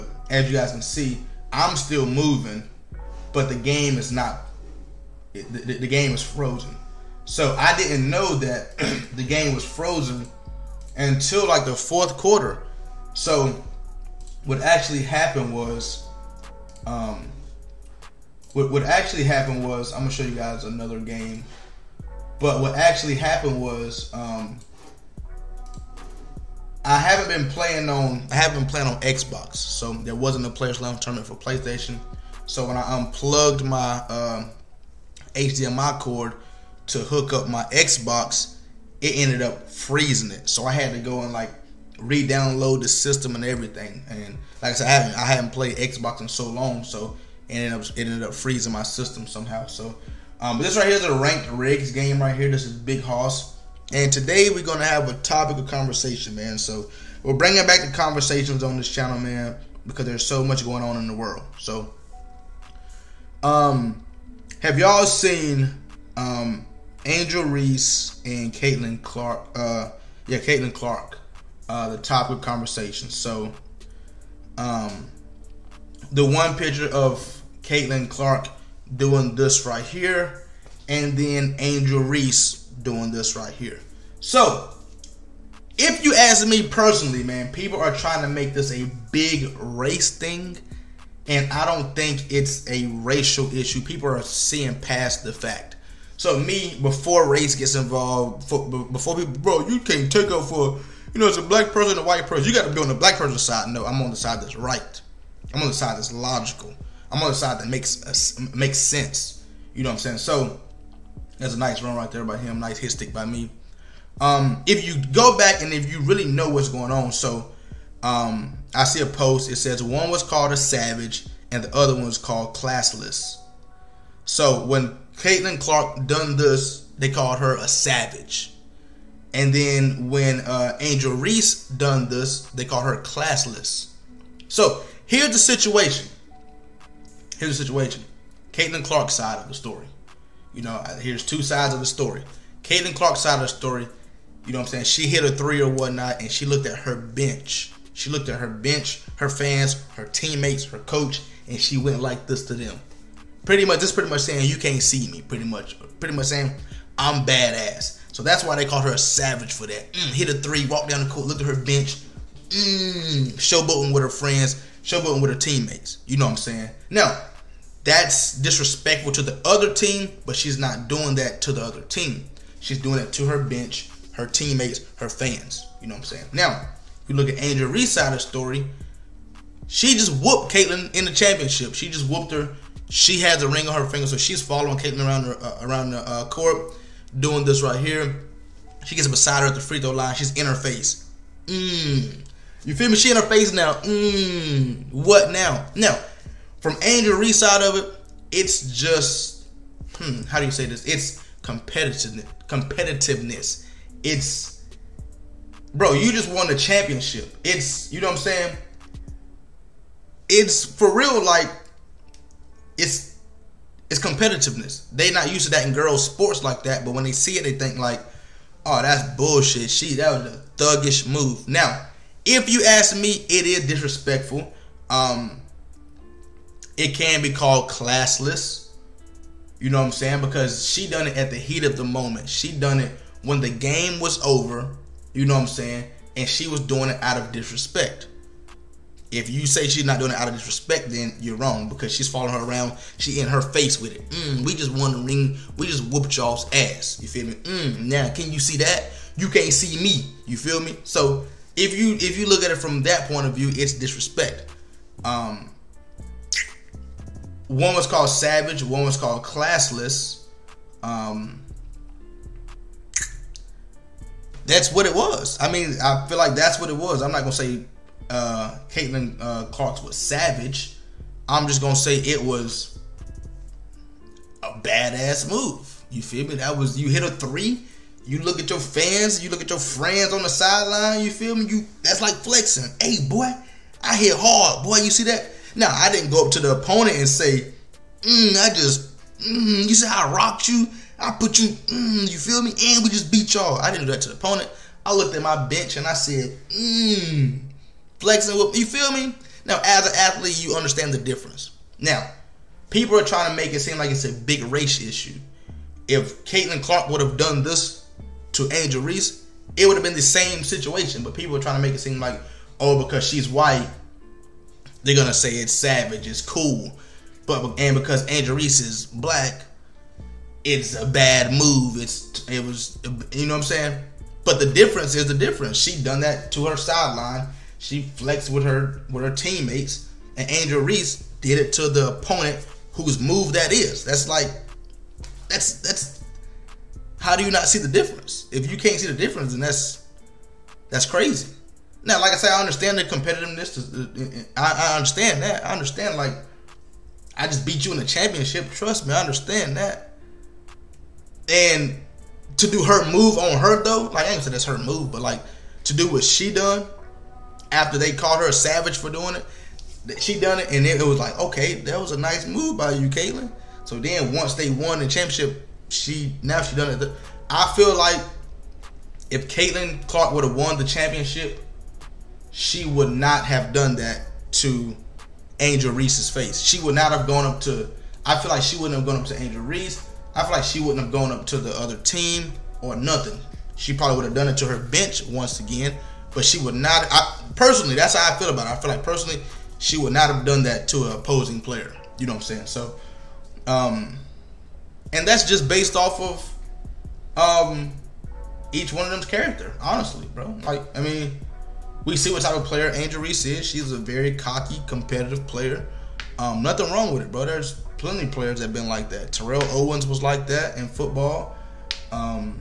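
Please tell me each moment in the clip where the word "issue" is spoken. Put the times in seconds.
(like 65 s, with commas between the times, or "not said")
93 s, 304 s.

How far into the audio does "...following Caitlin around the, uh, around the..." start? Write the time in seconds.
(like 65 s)
184 s.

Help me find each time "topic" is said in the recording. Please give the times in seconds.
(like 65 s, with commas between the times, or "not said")
55 s, 71 s.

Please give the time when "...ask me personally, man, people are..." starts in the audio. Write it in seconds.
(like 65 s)
86 s.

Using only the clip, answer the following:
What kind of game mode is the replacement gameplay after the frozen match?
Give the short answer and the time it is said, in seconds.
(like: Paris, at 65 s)
ranked regs, at 51 s.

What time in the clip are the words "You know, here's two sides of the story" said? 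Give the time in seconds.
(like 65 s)
140 s.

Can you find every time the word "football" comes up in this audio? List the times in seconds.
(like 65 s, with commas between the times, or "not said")
410 s.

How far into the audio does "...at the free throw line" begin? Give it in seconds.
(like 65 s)
189 s.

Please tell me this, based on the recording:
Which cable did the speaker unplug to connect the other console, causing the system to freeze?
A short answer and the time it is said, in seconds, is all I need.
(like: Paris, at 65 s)
HDMI cord, at 35 s.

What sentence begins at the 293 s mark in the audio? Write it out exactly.
I didn't do that to the opponent.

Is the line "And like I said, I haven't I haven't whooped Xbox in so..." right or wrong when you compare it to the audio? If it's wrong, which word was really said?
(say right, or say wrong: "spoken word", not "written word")
wrong: "played", not "whooped".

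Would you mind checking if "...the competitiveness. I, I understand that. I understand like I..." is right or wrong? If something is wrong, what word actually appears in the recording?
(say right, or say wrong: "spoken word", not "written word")
right.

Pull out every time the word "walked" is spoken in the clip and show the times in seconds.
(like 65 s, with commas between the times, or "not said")
160 s.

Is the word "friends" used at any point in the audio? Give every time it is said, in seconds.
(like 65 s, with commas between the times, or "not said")
164 s, 279 s.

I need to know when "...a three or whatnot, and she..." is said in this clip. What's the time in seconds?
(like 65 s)
145 s.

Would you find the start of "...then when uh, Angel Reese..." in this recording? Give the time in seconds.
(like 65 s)
129 s.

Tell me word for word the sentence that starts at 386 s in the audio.
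I, personally, that's how I feel about it.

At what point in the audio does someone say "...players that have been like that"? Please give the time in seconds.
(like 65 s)
408 s.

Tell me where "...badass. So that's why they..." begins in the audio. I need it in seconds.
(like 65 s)
157 s.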